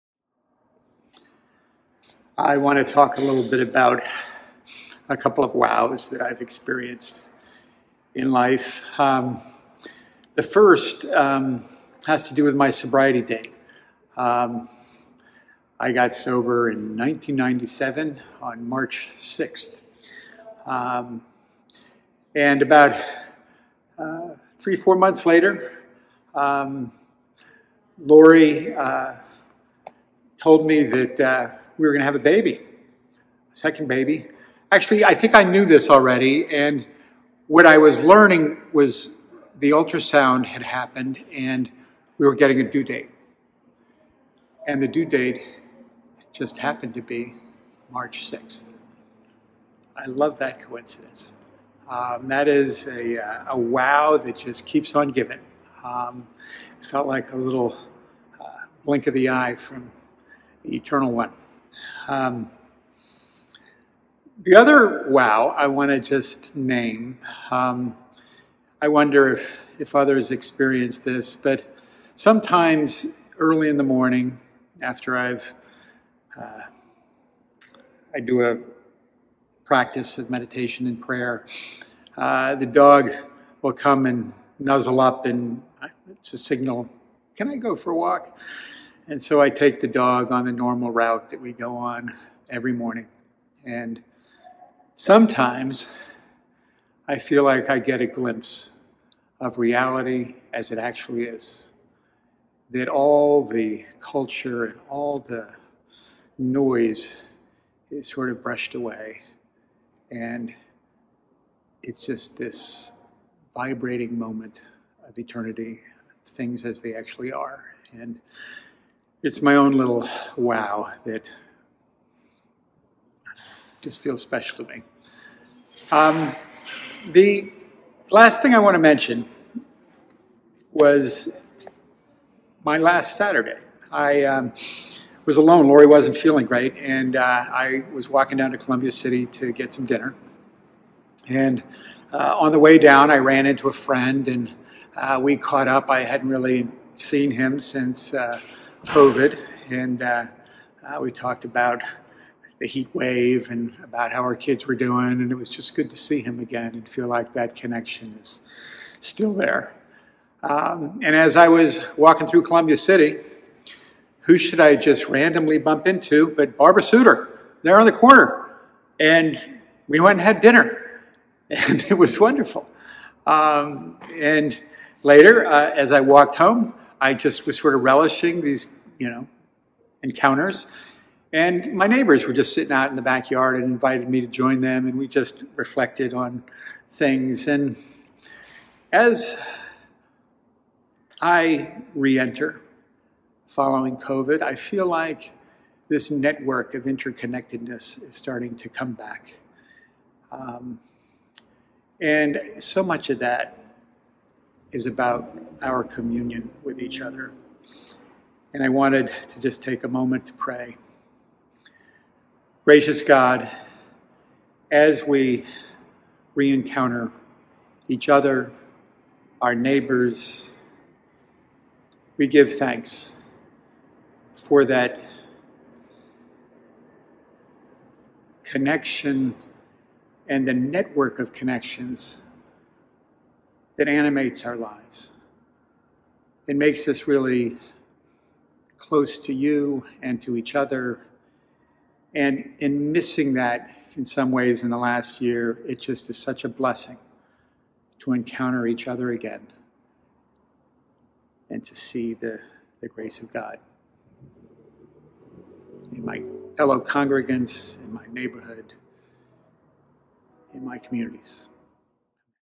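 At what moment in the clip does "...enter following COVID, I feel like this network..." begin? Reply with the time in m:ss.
3:12.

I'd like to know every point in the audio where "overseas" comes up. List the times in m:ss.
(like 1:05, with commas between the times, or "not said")
not said.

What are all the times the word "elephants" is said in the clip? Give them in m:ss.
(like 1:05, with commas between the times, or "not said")
not said.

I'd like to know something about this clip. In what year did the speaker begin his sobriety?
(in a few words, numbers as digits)
1997.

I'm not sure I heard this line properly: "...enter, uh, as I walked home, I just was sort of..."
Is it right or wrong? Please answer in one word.
wrong.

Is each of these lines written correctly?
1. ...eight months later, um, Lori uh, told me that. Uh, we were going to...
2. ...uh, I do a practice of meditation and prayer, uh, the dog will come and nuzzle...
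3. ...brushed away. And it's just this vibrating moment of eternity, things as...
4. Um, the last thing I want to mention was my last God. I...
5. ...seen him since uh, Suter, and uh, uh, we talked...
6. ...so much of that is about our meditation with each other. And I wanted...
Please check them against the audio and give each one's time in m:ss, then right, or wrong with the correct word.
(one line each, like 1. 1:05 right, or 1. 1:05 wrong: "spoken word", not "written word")
1. 0:24 wrong: "four", not "eight"
2. 1:16 right
3. 1:48 right
4. 2:05 wrong: "Saturday", not "God"
5. 2:26 wrong: "COVID", not "Suter"
6. 3:22 wrong: "communion", not "meditation".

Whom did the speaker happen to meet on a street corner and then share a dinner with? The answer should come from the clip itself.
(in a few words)
Barbara Suter.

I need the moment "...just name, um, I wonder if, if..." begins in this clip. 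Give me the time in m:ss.
1:05.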